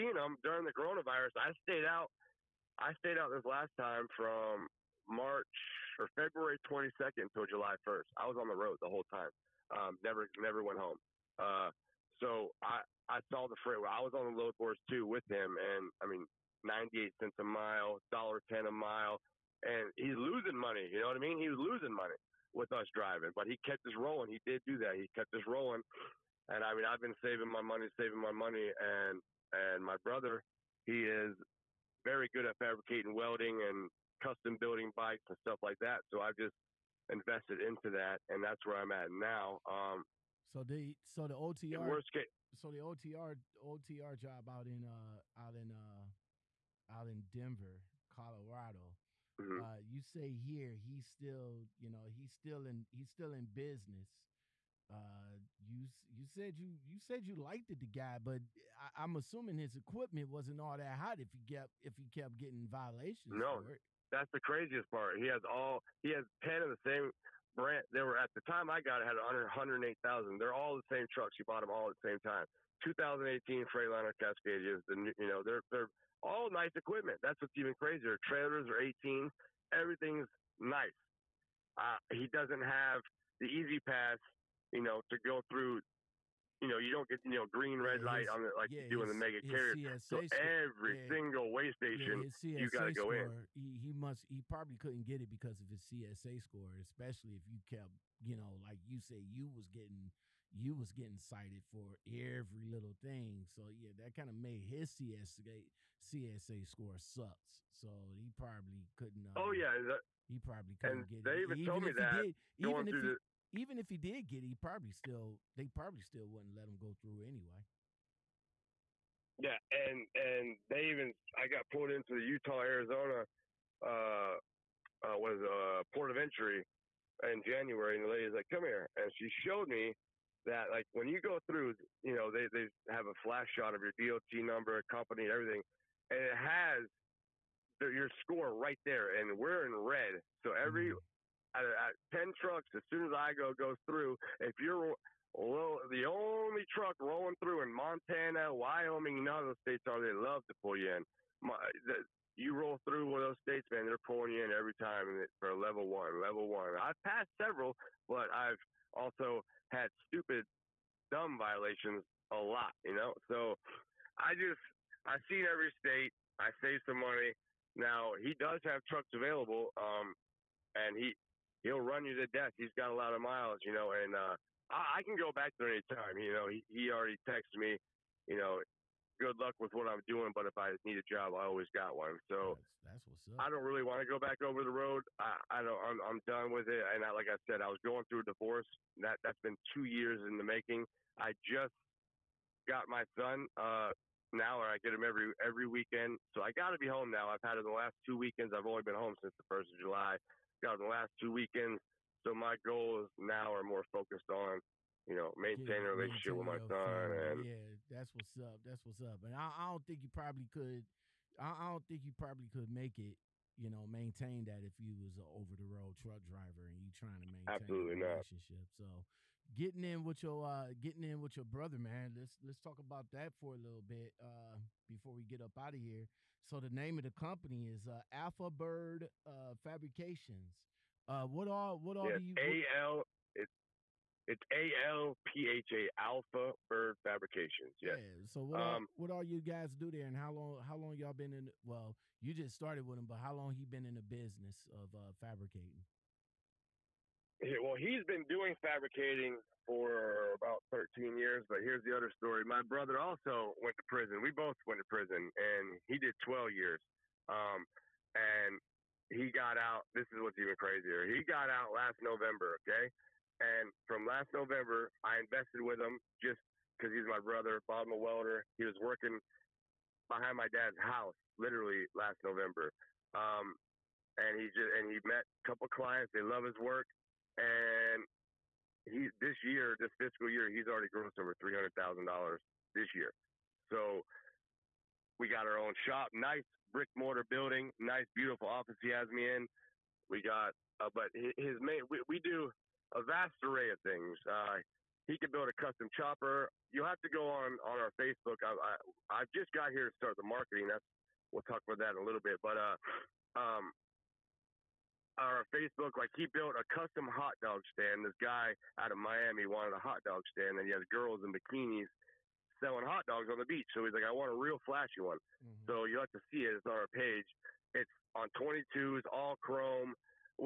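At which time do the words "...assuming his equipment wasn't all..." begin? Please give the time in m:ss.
0:59.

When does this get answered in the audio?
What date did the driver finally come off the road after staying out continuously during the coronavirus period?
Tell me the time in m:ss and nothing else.
0:07.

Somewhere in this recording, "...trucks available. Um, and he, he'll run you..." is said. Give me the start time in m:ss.
2:48.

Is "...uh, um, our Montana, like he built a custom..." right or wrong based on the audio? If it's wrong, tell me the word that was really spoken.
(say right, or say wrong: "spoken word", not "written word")
wrong: "Facebook", not "Montana".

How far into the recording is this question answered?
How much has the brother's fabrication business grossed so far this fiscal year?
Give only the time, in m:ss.
4:41.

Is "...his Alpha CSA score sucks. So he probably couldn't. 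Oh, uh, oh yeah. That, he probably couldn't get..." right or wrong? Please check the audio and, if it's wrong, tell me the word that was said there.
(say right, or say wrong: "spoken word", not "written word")
wrong: "CSA", not "Alpha".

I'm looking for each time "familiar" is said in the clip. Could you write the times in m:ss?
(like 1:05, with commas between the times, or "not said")
not said.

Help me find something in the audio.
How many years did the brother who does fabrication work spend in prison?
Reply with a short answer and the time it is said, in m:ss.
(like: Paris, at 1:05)
12 years, at 4:16.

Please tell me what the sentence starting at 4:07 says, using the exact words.
Yeah, well, he's been doing fabricating for about 13 years, but here's the other story.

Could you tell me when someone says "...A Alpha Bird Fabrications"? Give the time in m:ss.
3:55.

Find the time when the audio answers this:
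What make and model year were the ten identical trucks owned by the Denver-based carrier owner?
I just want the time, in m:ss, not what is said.
1:12.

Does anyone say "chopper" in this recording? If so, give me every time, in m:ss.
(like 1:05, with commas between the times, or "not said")
4:55.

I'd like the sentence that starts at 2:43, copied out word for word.
So I just, I've seen every state.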